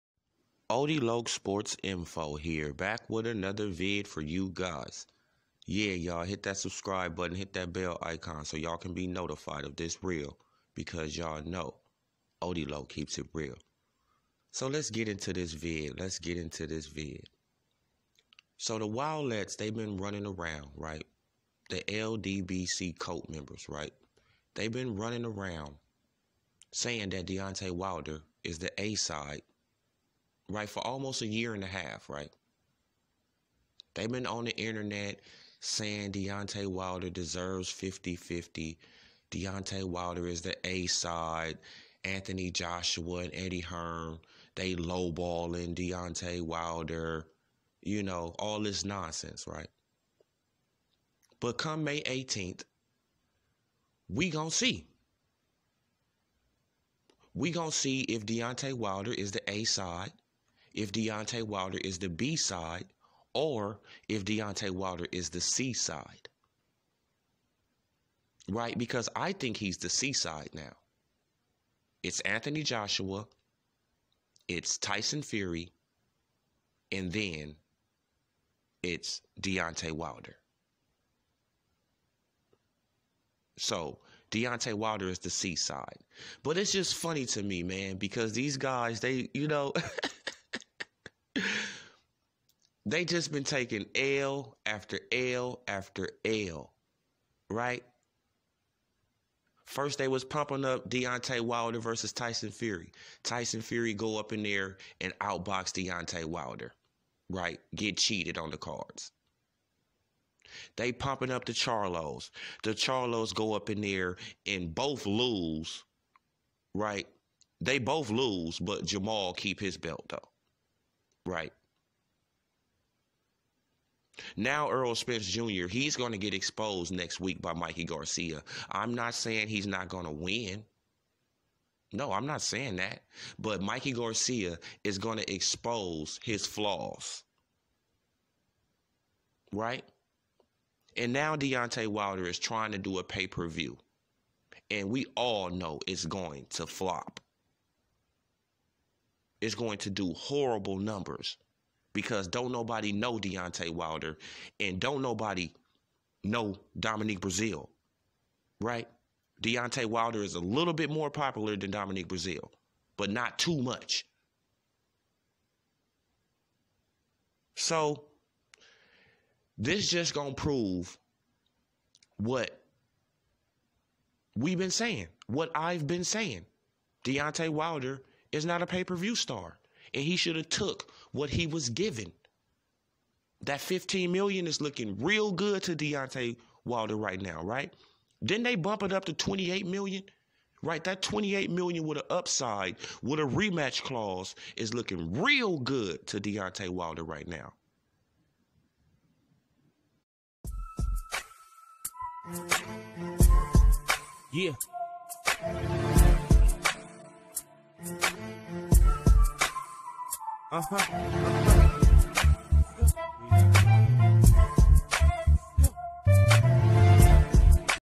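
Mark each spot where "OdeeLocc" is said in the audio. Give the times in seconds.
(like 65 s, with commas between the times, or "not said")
0 s, 12 s.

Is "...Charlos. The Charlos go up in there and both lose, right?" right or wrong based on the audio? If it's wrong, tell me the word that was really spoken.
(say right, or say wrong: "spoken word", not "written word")
right.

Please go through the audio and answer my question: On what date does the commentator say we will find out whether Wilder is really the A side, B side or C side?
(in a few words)
May 18th.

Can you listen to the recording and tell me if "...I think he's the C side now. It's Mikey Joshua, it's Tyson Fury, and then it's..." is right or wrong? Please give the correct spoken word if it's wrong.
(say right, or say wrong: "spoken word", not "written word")
wrong: "Anthony", not "Mikey".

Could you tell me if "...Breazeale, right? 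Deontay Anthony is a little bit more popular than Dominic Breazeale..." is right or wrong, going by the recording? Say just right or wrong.
wrong.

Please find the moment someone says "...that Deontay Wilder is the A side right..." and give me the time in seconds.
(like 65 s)
27 s.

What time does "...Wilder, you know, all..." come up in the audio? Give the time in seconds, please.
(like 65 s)
46 s.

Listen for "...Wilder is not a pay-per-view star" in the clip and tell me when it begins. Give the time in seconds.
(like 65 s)
177 s.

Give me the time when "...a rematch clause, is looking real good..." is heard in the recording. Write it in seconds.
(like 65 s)
193 s.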